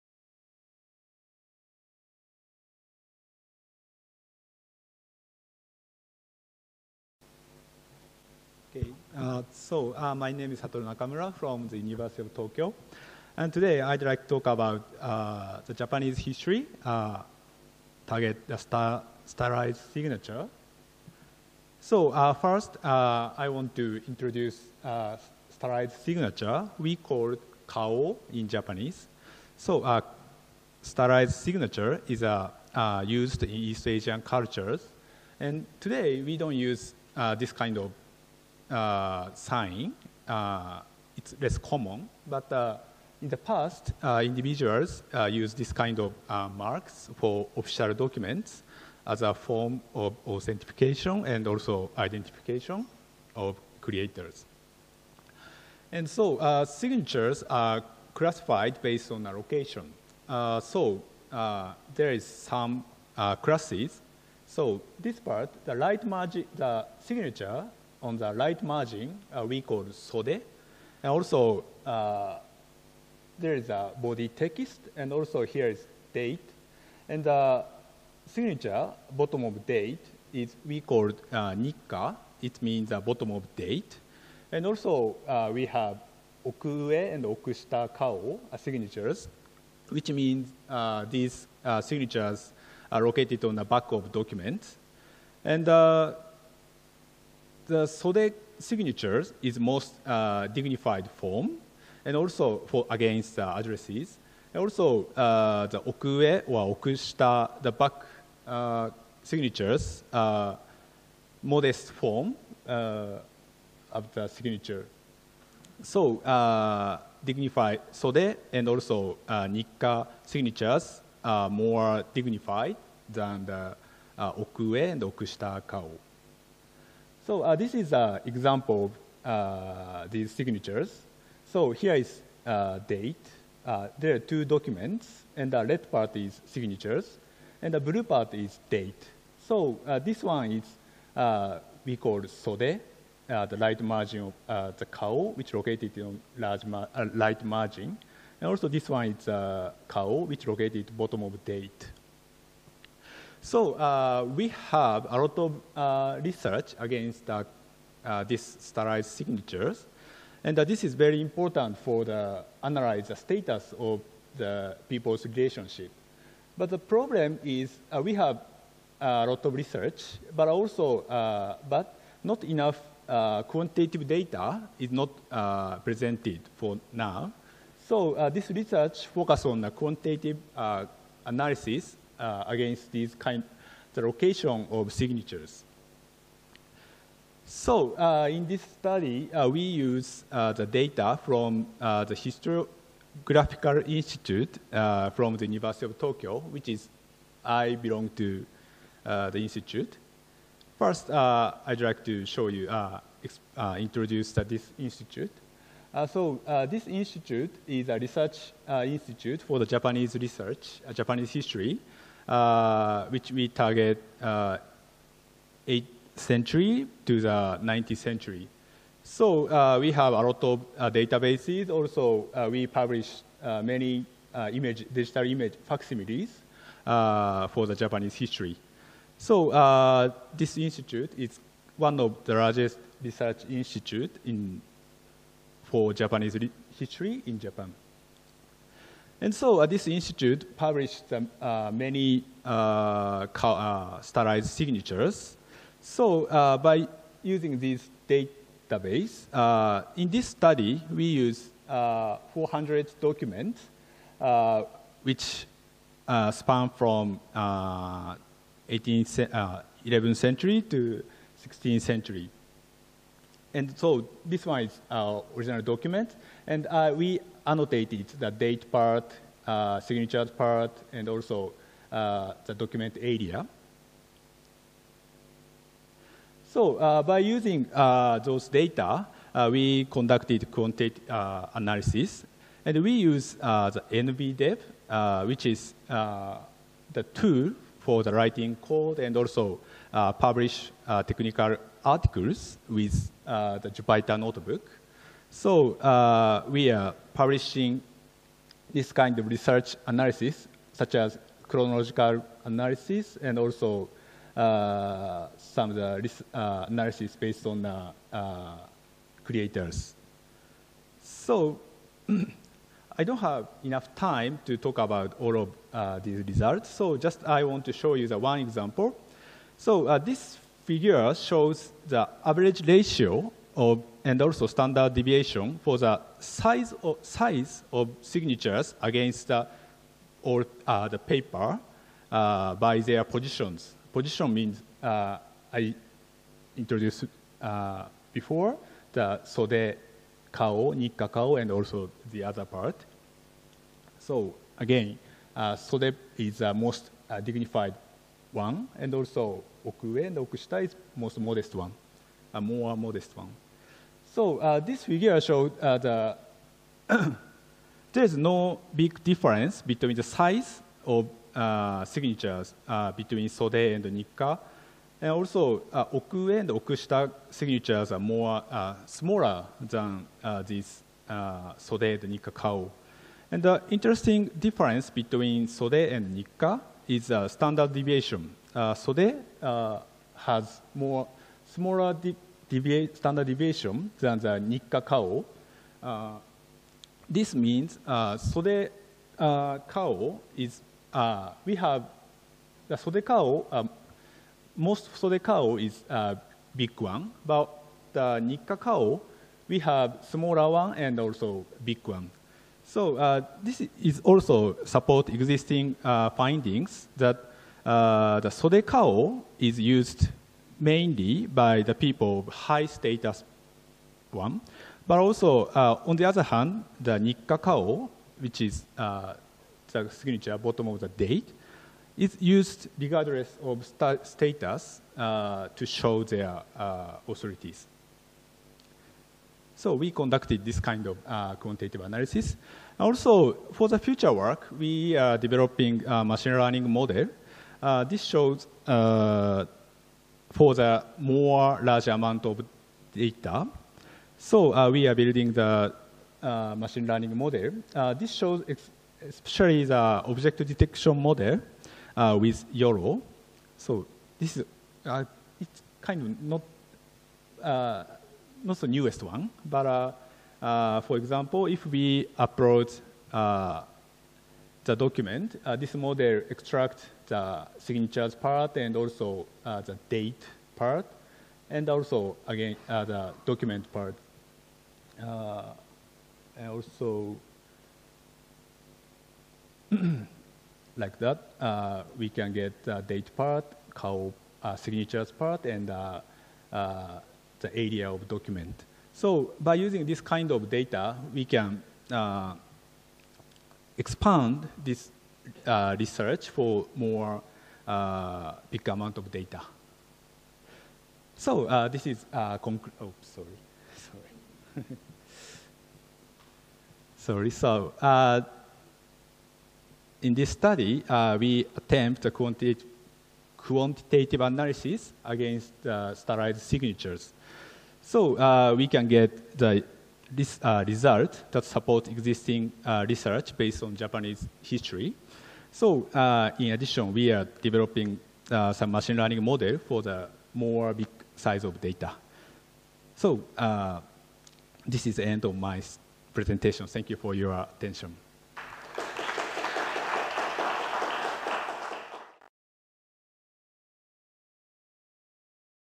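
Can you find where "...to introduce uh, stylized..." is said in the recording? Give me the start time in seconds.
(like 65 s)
23 s.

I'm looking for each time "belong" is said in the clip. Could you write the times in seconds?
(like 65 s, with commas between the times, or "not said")
197 s.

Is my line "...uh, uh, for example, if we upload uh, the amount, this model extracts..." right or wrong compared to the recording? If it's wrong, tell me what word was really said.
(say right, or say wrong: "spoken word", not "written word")
wrong: "document", not "amount".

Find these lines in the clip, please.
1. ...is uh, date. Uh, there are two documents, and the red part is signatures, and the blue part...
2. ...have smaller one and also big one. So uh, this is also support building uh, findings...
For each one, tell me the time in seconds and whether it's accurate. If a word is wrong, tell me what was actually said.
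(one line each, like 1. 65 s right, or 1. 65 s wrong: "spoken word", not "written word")
1. 131 s right
2. 399 s wrong: "existing", not "building".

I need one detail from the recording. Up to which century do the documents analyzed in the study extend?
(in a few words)
16th century.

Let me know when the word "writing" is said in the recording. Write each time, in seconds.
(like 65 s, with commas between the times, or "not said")
288 s.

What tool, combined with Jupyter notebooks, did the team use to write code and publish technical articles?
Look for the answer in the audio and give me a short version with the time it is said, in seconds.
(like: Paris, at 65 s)
nbdev, at 283 s.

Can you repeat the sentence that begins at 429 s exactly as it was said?
So we conducted this kind of uh, quantitative analysis.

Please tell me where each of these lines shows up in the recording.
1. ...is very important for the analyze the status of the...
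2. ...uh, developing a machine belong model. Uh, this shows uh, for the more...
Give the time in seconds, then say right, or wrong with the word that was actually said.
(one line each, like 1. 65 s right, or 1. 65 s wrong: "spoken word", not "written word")
1. 160 s right
2. 435 s wrong: "learning", not "belong".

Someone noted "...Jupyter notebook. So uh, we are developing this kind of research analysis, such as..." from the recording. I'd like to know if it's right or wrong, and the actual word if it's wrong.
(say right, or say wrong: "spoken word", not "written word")
wrong: "publishing", not "developing".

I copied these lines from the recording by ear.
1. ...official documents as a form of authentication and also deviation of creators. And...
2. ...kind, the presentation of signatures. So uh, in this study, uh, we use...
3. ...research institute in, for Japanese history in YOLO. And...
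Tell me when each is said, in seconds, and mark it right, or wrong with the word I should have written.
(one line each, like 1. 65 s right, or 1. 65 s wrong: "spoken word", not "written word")
1. 47 s wrong: "identification", not "deviation"
2. 183 s wrong: "location", not "presentation"
3. 233 s wrong: "Japan", not "YOLO".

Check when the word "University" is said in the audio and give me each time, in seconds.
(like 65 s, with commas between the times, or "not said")
11 s, 195 s.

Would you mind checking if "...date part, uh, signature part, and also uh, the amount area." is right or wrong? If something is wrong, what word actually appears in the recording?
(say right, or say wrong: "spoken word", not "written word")
wrong: "document", not "amount".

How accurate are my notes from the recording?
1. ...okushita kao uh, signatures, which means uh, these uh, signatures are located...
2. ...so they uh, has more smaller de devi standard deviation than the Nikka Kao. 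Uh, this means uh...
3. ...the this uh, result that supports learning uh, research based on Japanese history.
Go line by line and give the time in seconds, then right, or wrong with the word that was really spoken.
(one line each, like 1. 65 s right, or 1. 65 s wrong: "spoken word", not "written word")
1. 87 s right
2. 378 s right
3. 519 s wrong: "existing", not "learning".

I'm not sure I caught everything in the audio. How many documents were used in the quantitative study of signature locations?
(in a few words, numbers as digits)
400.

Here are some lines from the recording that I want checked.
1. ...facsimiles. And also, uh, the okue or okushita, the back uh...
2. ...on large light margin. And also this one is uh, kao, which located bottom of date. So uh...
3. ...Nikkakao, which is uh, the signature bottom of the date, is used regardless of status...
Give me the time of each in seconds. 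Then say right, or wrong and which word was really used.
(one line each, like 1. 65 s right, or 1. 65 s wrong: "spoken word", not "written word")
1. 103 s wrong: "addresses", not "facsimiles"
2. 145 s right
3. 416 s right.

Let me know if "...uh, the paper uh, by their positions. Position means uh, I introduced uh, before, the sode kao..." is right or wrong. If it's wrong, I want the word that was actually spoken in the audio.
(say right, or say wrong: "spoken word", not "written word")
right.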